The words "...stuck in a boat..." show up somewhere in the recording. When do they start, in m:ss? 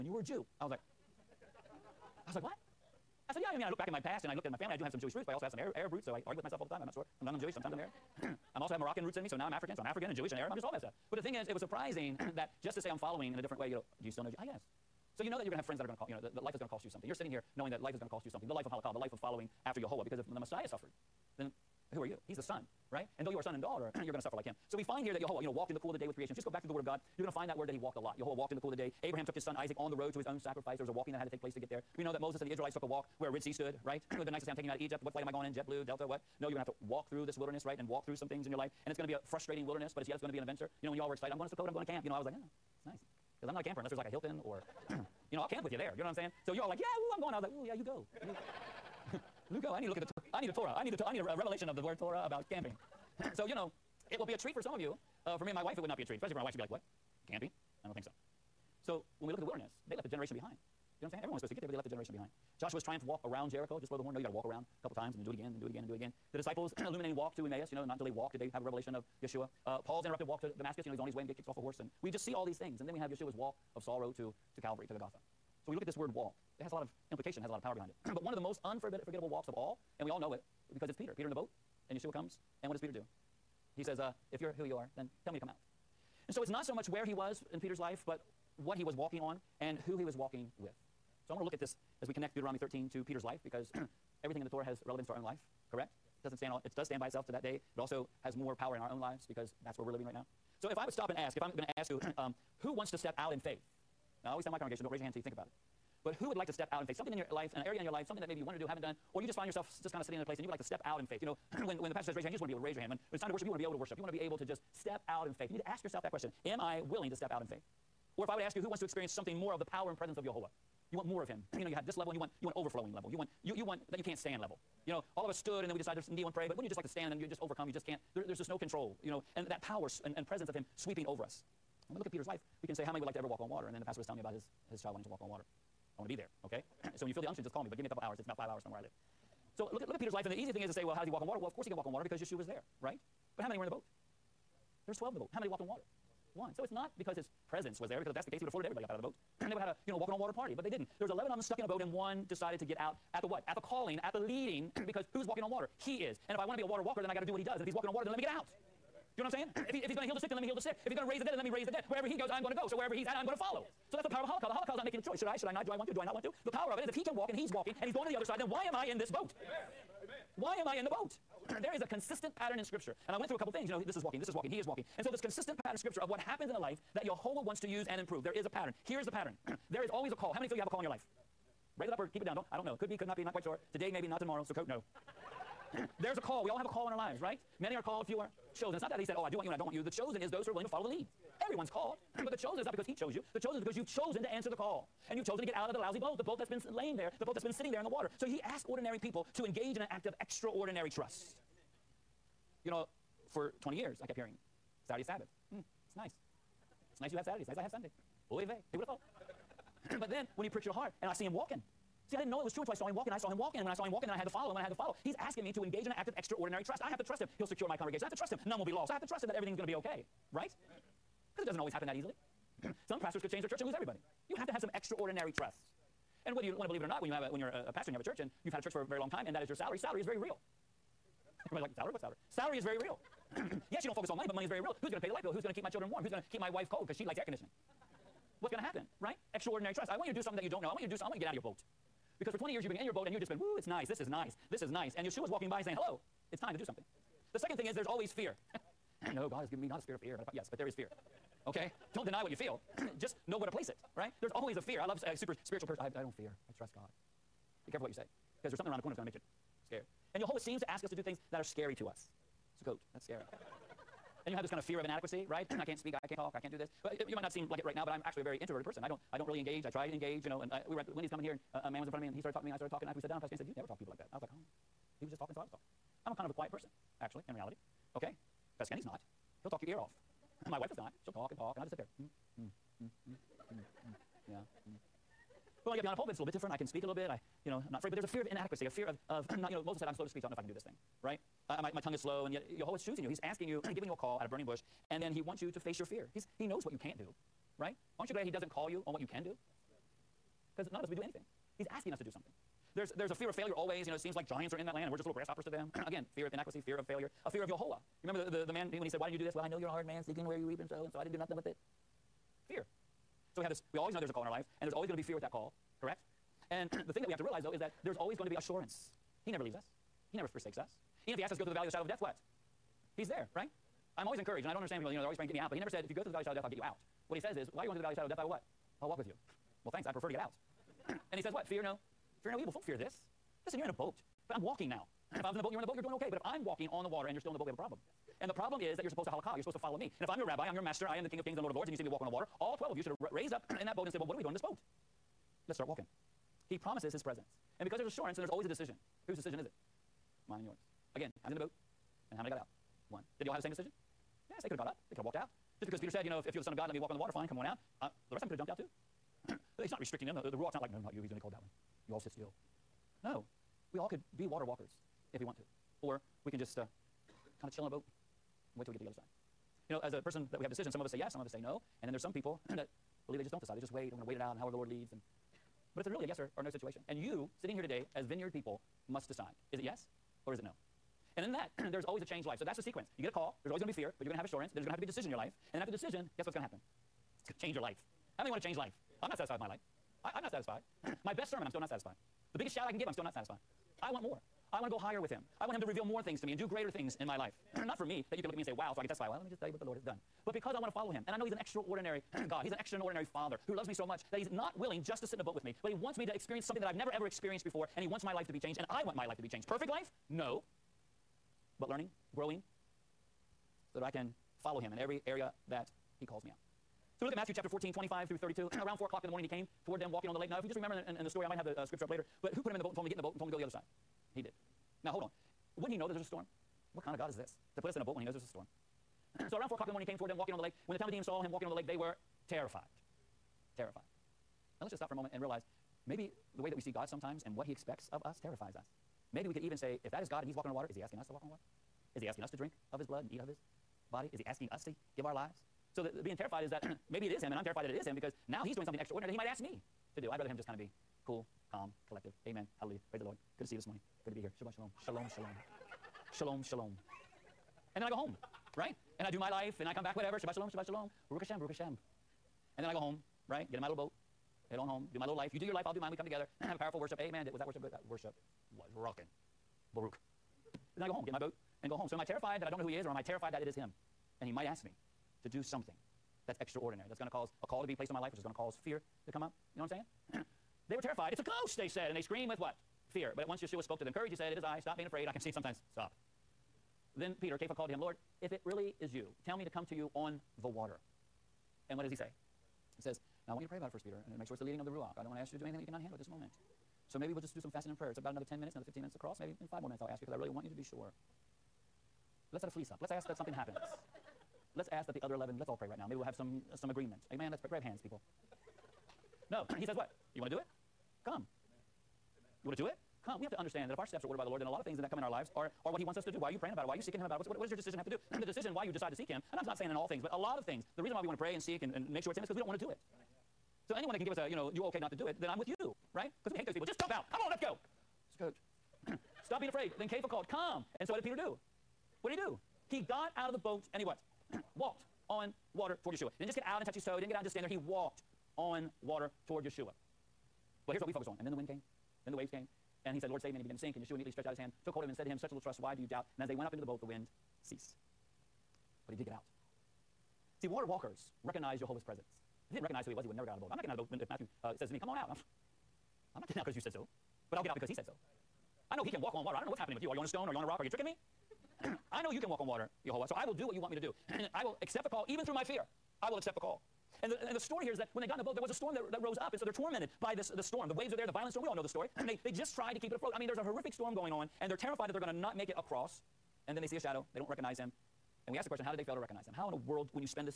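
2:31.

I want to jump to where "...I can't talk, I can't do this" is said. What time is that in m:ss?
4:26.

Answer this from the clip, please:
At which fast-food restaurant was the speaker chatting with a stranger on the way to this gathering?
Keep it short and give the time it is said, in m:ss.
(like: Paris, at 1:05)
Wendy's, at 4:30.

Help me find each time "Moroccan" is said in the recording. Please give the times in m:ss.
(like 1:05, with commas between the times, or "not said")
0:08.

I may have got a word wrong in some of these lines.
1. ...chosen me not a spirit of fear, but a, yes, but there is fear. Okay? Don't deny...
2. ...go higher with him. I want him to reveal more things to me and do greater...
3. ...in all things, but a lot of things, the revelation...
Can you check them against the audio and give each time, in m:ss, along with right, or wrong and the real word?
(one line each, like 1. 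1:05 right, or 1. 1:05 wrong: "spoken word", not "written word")
1. 4:09 wrong: "given", not "chosen"
2. 6:34 right
3. 8:39 wrong: "reason", not "revelation".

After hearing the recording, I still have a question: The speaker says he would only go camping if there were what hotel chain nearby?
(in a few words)
Hilton.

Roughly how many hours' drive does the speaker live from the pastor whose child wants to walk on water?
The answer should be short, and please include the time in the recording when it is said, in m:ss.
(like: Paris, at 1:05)
5, at 2:18.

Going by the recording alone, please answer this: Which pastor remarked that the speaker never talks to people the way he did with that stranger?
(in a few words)
Pastor Gaines.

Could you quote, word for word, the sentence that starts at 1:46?
But who would like to step out in faith?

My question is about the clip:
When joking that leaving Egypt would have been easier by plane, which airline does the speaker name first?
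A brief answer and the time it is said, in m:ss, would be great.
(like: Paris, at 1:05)
JetBlue, at 0:35.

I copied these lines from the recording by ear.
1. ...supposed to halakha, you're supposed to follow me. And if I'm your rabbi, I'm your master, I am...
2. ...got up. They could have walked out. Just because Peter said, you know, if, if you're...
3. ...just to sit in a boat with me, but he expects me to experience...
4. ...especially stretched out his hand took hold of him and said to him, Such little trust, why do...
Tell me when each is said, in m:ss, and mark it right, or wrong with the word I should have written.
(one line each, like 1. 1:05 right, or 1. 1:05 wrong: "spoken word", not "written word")
1. 5:38 right
2. 5:54 right
3. 6:44 wrong: "wants", not "expects"
4. 9:03 wrong: "immediately", not "especially".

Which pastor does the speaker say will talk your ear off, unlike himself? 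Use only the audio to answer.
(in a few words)
Pastor Kenny.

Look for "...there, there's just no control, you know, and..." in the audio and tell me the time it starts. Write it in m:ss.
2:08.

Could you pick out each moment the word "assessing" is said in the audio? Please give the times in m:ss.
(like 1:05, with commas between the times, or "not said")
not said.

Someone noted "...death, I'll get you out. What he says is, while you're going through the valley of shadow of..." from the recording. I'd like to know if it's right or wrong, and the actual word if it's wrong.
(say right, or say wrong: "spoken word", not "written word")
right.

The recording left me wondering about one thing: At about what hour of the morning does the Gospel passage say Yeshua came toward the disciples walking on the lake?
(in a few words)
4 o'clock.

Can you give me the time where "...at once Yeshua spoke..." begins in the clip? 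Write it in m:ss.
8:03.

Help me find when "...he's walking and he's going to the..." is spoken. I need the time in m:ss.
2:47.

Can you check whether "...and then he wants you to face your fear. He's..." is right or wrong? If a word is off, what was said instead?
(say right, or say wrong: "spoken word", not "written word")
right.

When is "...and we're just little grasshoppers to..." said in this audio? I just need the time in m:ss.
5:04.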